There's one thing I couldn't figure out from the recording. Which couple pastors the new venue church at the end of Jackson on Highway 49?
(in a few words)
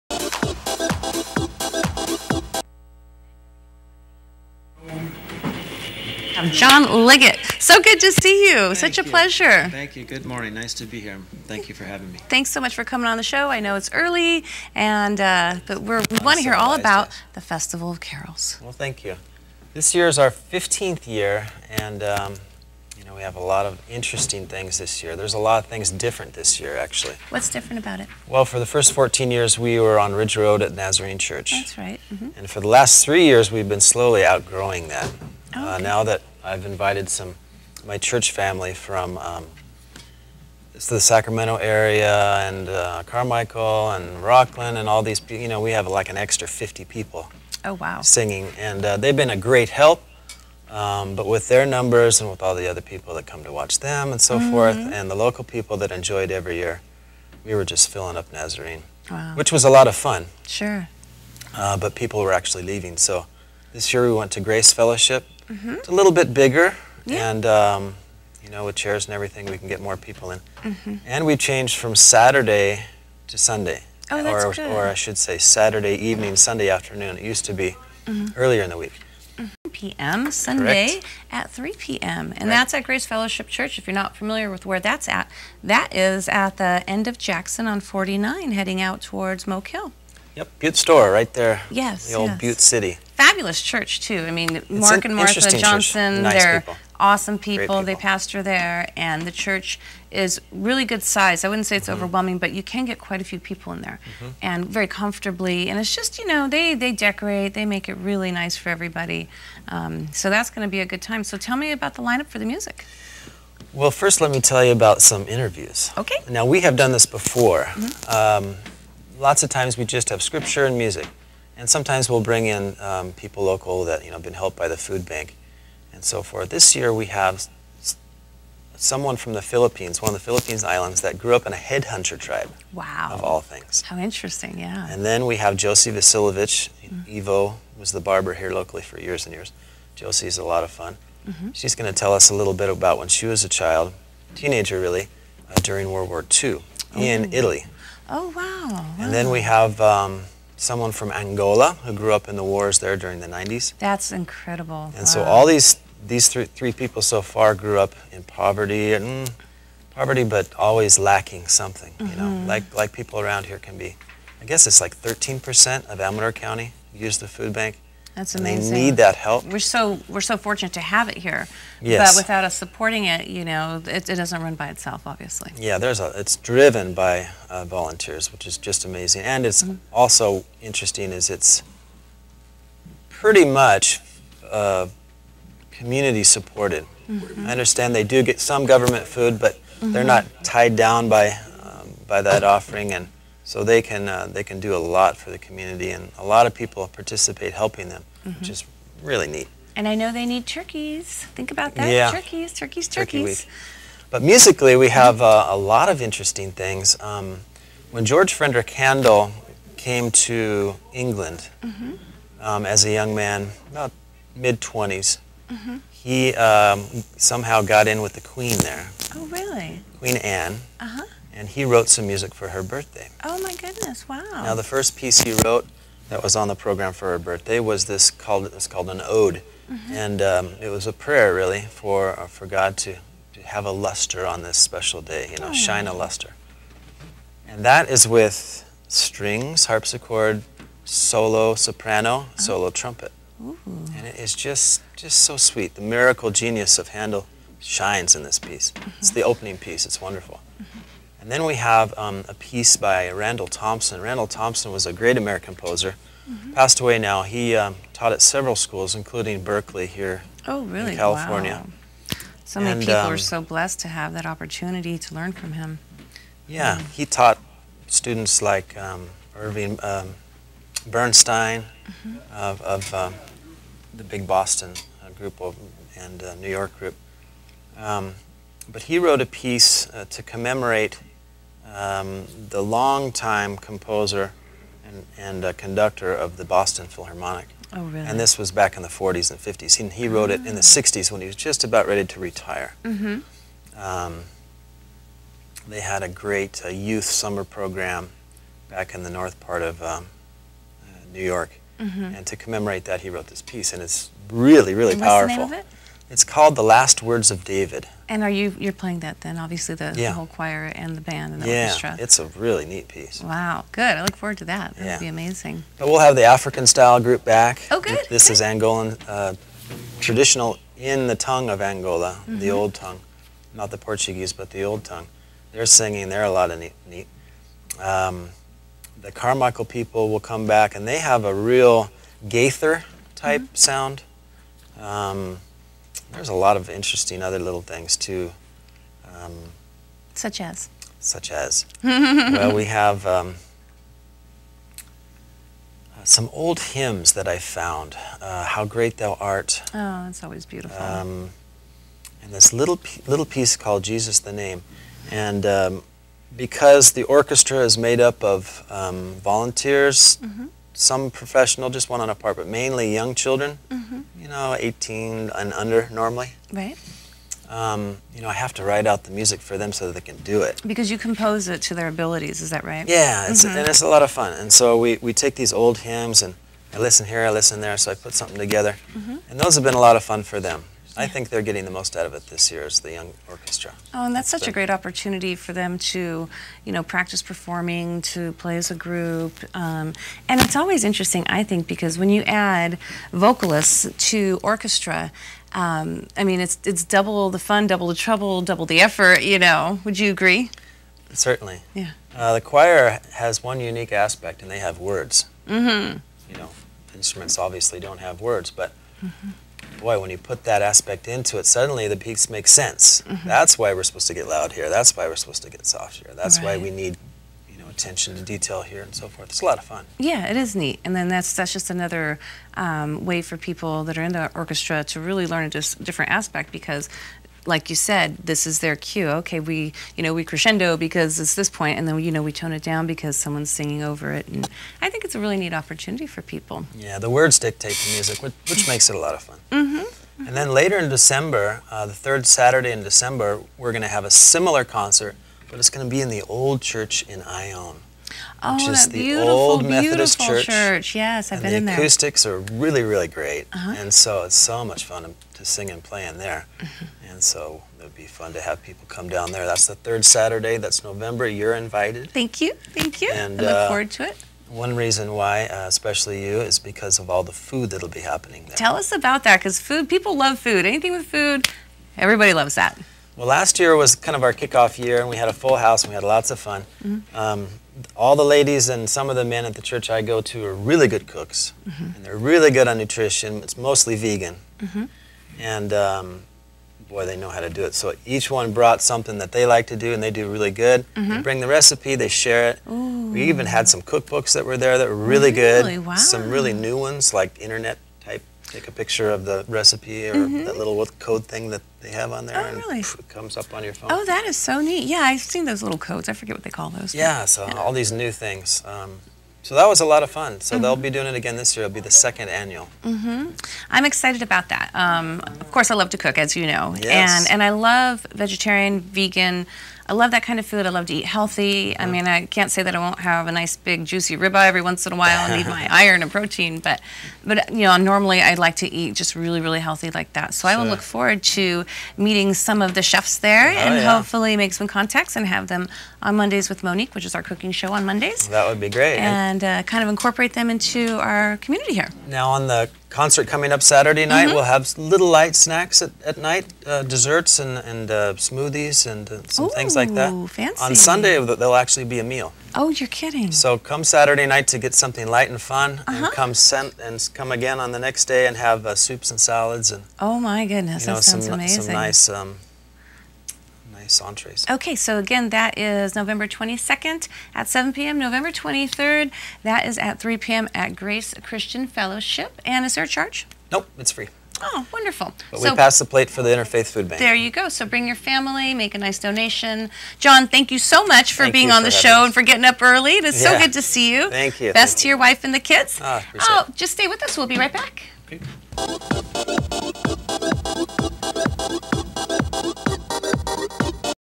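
Mark and Martha Johnson.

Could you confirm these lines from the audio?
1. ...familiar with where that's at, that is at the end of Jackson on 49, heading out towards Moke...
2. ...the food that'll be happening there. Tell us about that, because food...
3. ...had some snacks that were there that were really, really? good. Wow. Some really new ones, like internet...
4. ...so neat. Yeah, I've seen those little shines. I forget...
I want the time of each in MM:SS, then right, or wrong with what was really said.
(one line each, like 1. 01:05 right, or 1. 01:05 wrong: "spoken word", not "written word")
1. 01:24 right
2. 07:47 right
3. 08:13 wrong: "cookbooks", not "snacks"
4. 08:24 wrong: "codes", not "shines".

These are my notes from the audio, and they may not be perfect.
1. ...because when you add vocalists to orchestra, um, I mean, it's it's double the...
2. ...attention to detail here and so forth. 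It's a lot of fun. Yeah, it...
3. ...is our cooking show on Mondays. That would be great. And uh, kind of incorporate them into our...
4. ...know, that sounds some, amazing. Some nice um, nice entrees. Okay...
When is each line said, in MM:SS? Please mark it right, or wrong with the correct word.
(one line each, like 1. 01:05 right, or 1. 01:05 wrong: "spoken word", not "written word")
1. 06:31 right
2. 06:57 right
3. 08:57 right
4. 09:20 right.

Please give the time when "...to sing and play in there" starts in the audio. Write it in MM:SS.
07:35.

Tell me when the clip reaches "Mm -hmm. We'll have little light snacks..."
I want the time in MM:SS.
09:04.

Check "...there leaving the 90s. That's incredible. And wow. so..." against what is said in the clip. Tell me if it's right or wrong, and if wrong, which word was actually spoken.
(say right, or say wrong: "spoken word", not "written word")
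wrong: "during", not "leaving".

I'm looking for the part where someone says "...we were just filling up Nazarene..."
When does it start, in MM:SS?
00:57.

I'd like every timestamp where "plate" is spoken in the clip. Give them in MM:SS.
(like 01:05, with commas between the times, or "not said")
09:35.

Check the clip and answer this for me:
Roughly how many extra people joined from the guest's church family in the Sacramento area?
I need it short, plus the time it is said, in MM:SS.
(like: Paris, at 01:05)
50, at 00:46.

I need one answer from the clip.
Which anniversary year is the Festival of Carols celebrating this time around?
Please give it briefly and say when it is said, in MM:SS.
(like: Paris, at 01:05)
15th, at 00:20.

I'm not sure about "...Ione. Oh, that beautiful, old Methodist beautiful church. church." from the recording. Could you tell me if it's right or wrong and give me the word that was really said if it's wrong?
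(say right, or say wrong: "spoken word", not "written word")
right.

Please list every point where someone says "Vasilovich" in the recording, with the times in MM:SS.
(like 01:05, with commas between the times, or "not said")
02:15.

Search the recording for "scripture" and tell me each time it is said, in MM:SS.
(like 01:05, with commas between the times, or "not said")
02:00.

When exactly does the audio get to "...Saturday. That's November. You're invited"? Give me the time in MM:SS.
07:40.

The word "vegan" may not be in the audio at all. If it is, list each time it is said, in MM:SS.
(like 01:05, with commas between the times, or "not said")
08:03, 08:38.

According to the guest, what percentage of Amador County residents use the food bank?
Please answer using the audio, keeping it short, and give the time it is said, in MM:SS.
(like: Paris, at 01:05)
13%, at 02:45.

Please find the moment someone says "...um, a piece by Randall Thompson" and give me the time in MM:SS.
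04:11.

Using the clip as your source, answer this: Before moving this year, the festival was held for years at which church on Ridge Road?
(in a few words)
Nazarene Church.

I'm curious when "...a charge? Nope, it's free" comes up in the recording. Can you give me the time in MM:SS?
09:32.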